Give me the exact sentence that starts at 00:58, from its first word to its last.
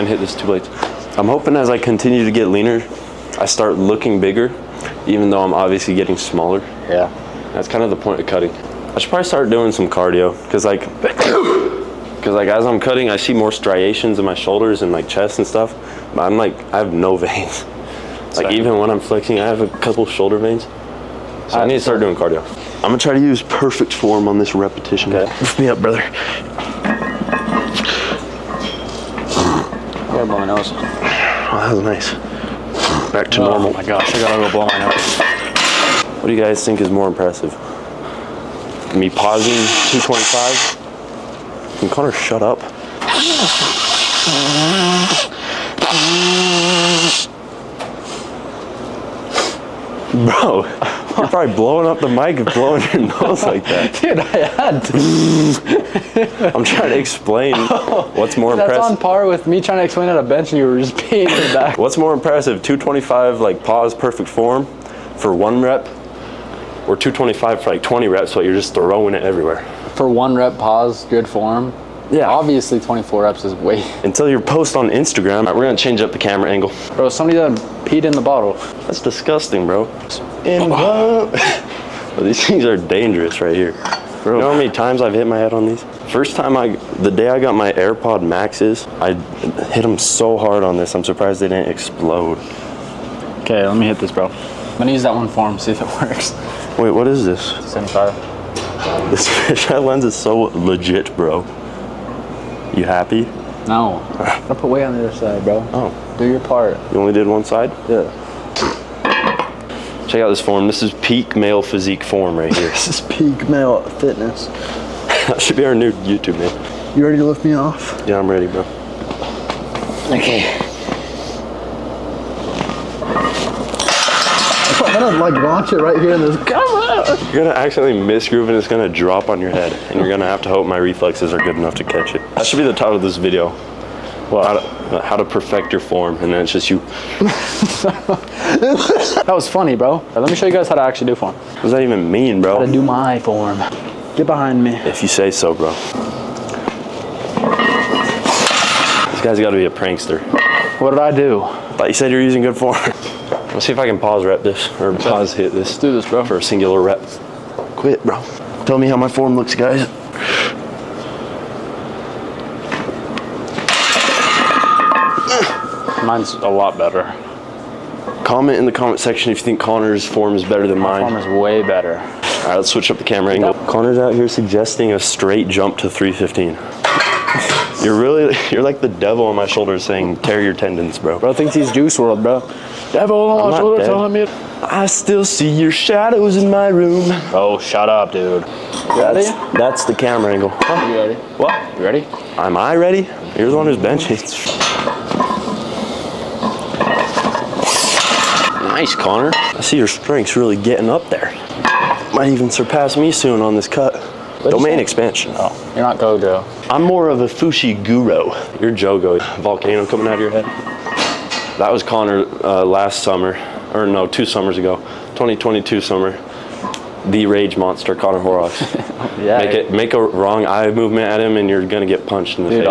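That's on par with me trying to explain at a bench and you were just peeing in the back.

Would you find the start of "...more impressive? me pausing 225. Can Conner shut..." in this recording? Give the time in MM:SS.
00:36.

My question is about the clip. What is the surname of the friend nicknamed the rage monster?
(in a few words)
Horrocks.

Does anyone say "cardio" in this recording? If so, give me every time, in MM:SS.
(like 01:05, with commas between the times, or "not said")
00:09, 00:22.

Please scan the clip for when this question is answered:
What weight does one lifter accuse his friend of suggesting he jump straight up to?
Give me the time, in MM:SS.
02:55.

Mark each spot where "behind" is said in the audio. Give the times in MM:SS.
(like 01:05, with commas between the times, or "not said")
02:24.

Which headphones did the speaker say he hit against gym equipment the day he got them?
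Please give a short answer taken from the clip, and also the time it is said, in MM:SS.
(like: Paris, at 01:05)
AirPod Maxes, at 01:27.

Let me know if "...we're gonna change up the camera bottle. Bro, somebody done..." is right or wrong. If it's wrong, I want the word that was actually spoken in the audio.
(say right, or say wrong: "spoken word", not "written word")
wrong: "angle", not "bottle".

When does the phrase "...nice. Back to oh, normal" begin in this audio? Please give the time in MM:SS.
00:31.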